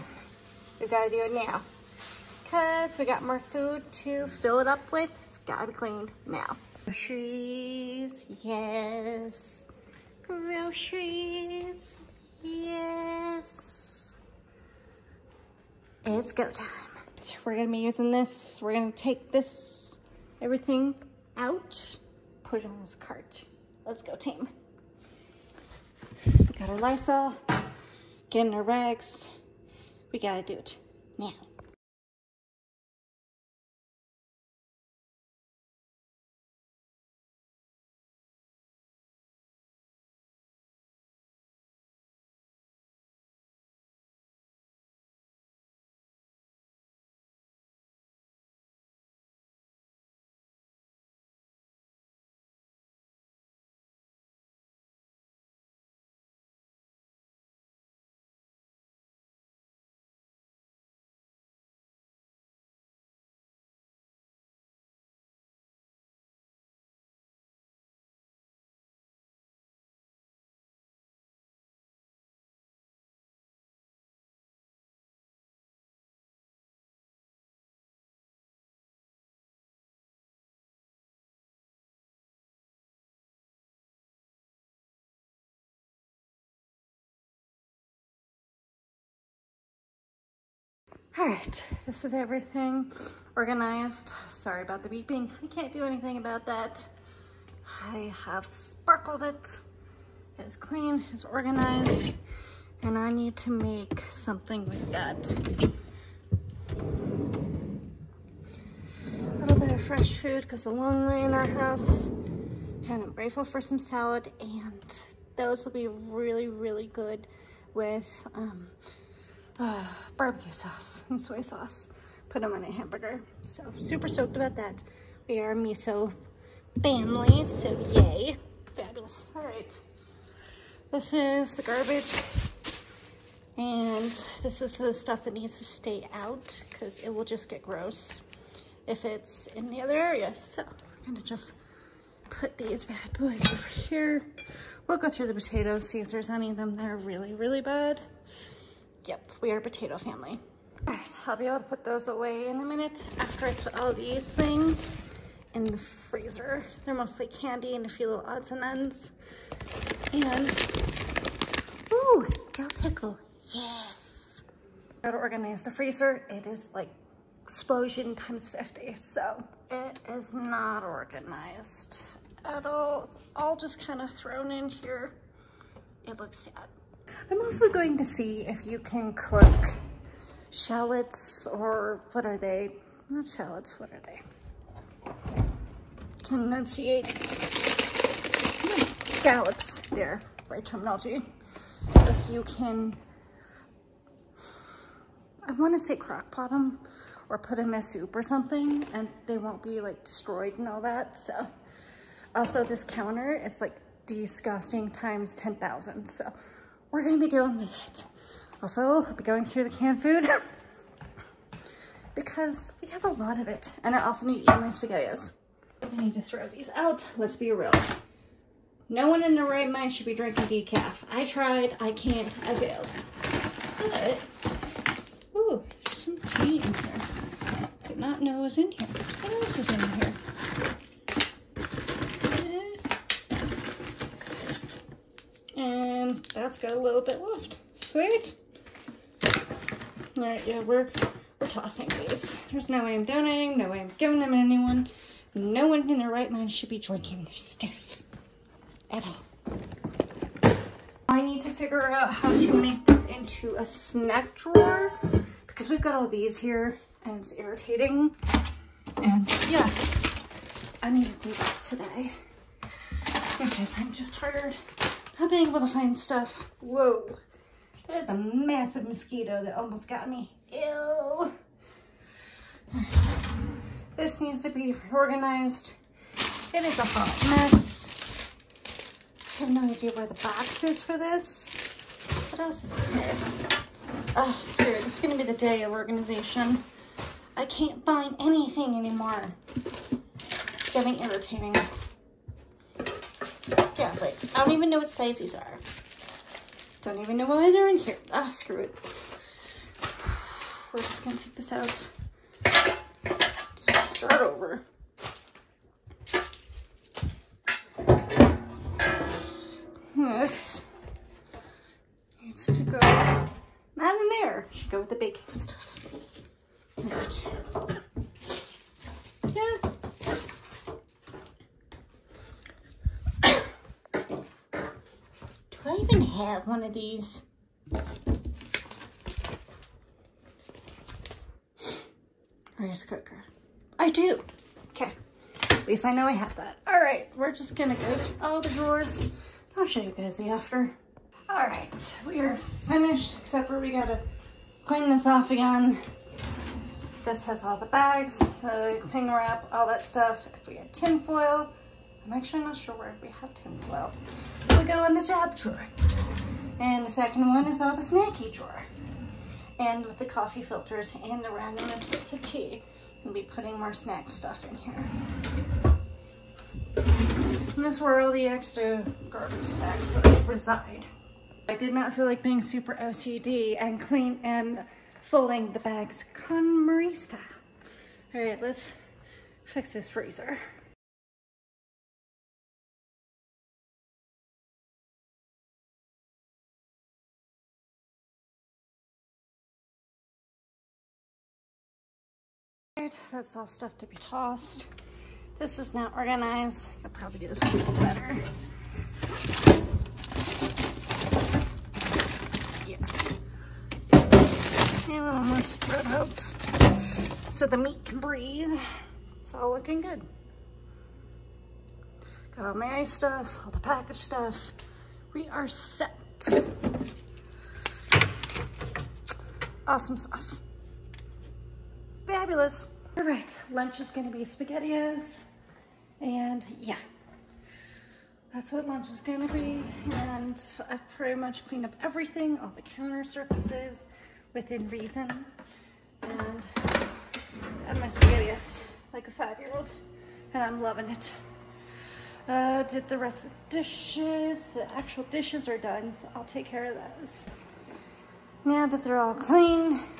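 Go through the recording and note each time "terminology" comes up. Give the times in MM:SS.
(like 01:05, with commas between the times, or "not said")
03:10.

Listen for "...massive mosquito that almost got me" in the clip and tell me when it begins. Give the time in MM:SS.
04:28.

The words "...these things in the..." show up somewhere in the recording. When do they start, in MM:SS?
02:33.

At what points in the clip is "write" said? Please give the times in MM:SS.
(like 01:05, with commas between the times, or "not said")
not said.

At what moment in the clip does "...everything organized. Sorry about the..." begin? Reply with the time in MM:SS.
01:32.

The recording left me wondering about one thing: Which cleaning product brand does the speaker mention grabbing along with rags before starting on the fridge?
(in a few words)
Lysol.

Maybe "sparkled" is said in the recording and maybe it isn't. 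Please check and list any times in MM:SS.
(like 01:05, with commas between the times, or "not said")
01:38.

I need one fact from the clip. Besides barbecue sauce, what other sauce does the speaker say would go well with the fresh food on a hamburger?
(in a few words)
soy sauce.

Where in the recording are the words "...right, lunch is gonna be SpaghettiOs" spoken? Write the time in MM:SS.
07:03.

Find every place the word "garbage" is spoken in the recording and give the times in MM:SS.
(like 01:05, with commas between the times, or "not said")
02:11, 06:09.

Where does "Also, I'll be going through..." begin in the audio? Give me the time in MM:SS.
03:28.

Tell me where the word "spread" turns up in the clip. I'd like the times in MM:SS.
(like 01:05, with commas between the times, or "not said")
06:45.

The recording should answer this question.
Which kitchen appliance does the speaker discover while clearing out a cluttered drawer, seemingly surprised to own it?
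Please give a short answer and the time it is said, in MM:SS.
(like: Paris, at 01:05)
rice cooker, at 05:32.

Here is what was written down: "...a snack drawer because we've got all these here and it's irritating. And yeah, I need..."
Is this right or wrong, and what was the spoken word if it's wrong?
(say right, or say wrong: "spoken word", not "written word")
right.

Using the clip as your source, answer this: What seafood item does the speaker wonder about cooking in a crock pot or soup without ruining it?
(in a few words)
scallops.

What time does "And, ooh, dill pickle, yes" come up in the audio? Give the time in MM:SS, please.
02:40.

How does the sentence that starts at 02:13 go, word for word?
And this is the stuff that needs to stay out because it will just get gross if it's in the other area.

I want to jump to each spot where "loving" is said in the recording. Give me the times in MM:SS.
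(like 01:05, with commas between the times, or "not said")
07:20.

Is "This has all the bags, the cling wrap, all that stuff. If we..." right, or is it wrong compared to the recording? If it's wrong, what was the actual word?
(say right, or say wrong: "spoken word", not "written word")
right.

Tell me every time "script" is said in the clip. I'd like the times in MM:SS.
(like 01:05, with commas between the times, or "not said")
not said.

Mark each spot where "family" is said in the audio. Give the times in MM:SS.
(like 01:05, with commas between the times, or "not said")
02:06, 02:29.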